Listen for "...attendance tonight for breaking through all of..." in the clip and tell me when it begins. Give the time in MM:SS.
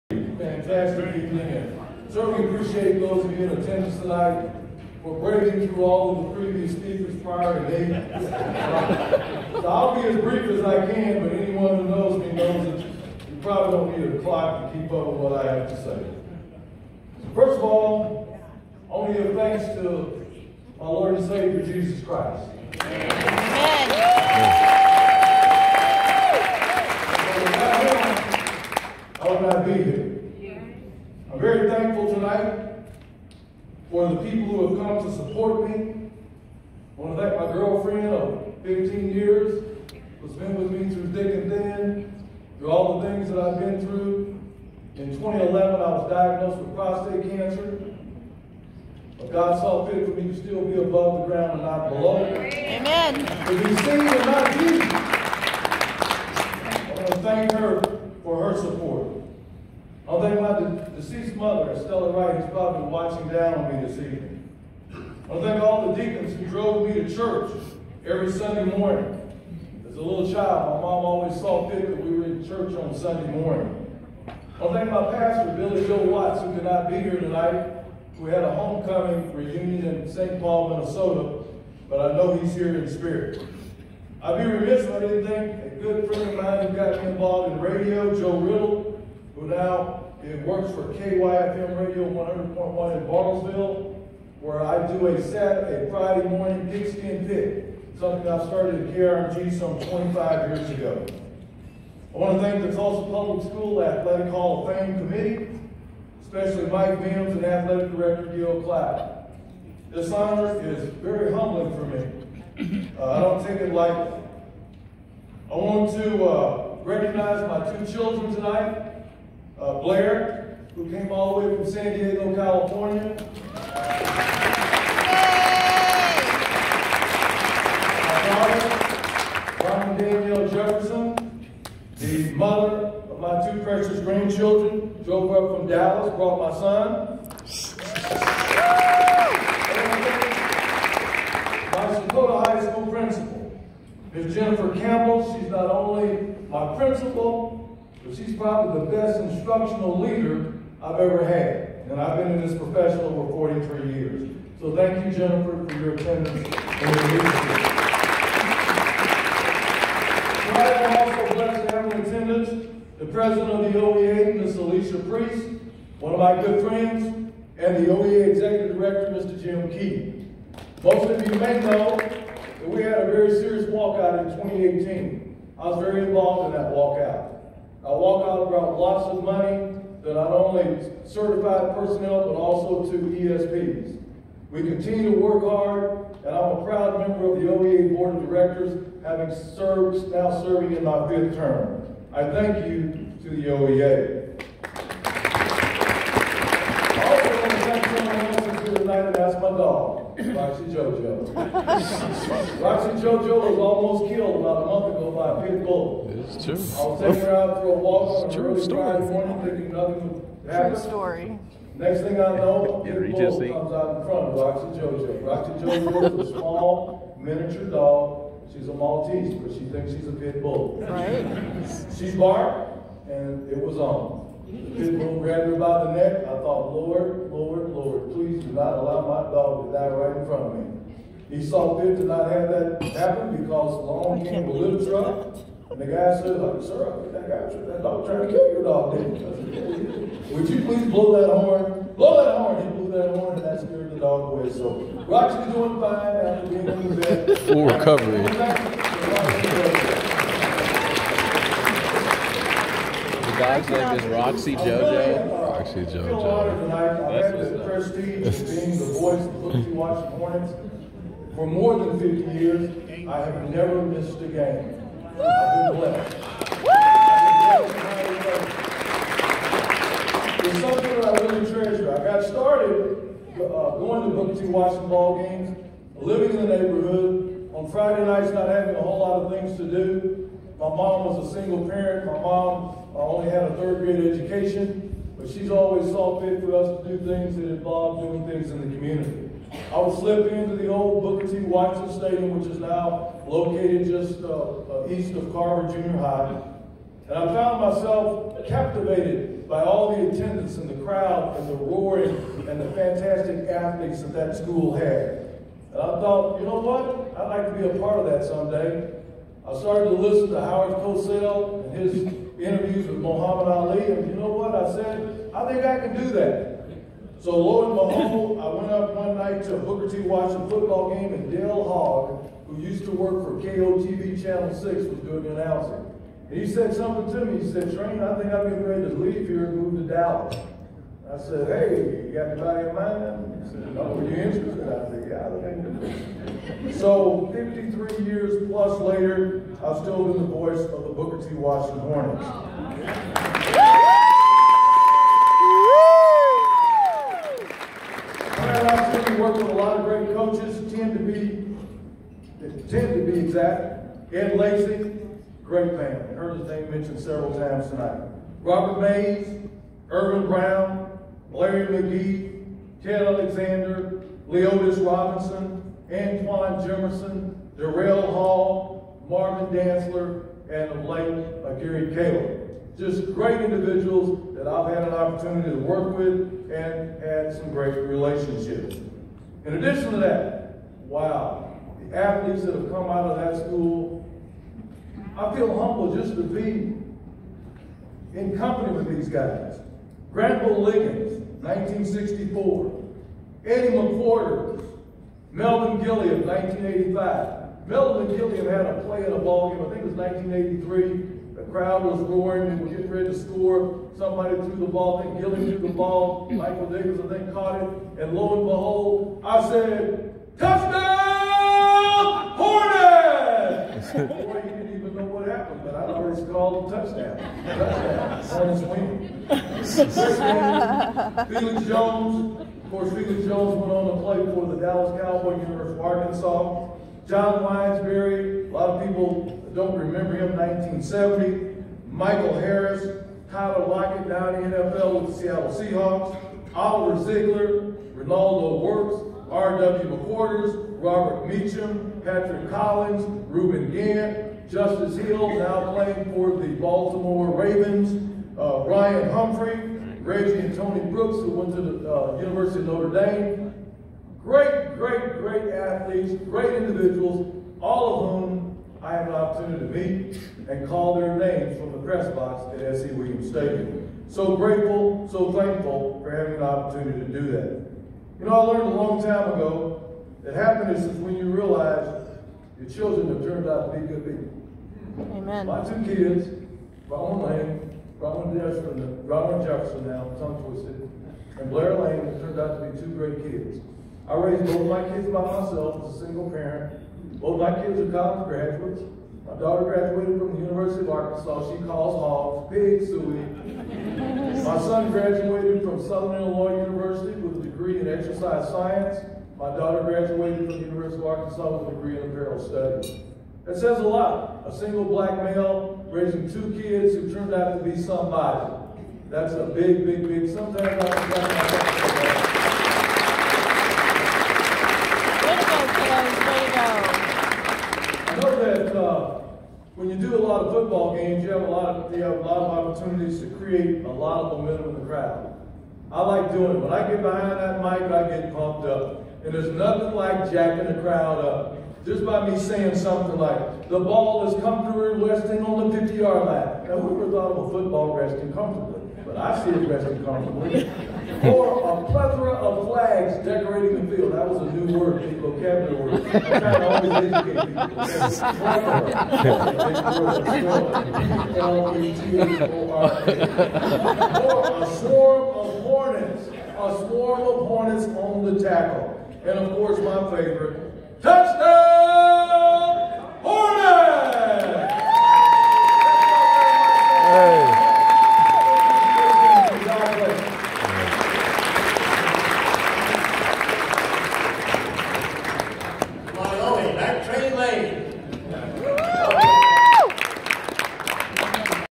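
00:03.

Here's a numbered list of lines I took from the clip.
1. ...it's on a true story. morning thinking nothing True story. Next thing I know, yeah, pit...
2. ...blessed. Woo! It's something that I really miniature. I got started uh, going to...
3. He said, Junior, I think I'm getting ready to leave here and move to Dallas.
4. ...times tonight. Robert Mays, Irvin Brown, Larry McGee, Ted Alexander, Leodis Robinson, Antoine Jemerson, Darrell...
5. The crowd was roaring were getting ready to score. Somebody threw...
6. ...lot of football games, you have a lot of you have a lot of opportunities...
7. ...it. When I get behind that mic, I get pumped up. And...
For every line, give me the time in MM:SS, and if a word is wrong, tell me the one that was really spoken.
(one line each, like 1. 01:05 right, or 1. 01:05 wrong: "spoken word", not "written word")
1. 03:28 right
2. 04:25 wrong: "treasure", not "miniature"
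3. 05:27 wrong: "Train", not "Junior"
4. 05:57 right
5. 06:41 right
6. 08:40 right
7. 08:46 right.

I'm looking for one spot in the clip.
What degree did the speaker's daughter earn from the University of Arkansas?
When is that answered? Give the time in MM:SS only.
08:22.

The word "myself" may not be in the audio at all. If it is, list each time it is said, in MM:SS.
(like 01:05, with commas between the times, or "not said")
04:57, 08:05.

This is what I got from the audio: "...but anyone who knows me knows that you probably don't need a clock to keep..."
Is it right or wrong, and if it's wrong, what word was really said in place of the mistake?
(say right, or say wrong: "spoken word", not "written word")
right.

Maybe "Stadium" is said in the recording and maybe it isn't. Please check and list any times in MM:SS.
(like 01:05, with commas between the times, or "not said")
04:51, 07:43.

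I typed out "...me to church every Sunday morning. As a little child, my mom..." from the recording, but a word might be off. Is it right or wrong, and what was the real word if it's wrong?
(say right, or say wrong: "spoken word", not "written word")
right.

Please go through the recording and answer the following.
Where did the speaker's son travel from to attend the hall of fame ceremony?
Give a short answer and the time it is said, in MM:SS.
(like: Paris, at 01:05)
San Diego, California, at 02:01.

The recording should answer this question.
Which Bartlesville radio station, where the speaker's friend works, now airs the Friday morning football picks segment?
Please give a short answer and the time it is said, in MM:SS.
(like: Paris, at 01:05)
KYFM Radio 100.1, at 01:30.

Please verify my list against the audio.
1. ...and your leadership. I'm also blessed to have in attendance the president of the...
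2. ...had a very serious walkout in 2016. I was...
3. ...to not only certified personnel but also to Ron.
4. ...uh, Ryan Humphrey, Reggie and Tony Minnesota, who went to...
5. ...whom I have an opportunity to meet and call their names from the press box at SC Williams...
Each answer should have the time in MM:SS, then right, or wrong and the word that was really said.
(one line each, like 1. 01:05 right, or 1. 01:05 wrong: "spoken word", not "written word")
1. 02:36 right
2. 02:52 wrong: "2018", not "2016"
3. 03:00 wrong: "ESPs", not "Ron"
4. 07:28 wrong: "Brooks", not "Minnesota"
5. 07:38 right.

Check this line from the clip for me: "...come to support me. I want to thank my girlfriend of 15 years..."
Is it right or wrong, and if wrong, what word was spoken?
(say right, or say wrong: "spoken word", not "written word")
right.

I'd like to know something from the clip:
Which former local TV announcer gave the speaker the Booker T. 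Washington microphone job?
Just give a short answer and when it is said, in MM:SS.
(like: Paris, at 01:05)
Dale Hogg, at 05:21.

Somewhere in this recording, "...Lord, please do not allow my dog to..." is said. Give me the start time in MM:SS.
03:47.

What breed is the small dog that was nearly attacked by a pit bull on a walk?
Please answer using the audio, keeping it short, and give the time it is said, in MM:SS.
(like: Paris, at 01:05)
Maltese, at 03:38.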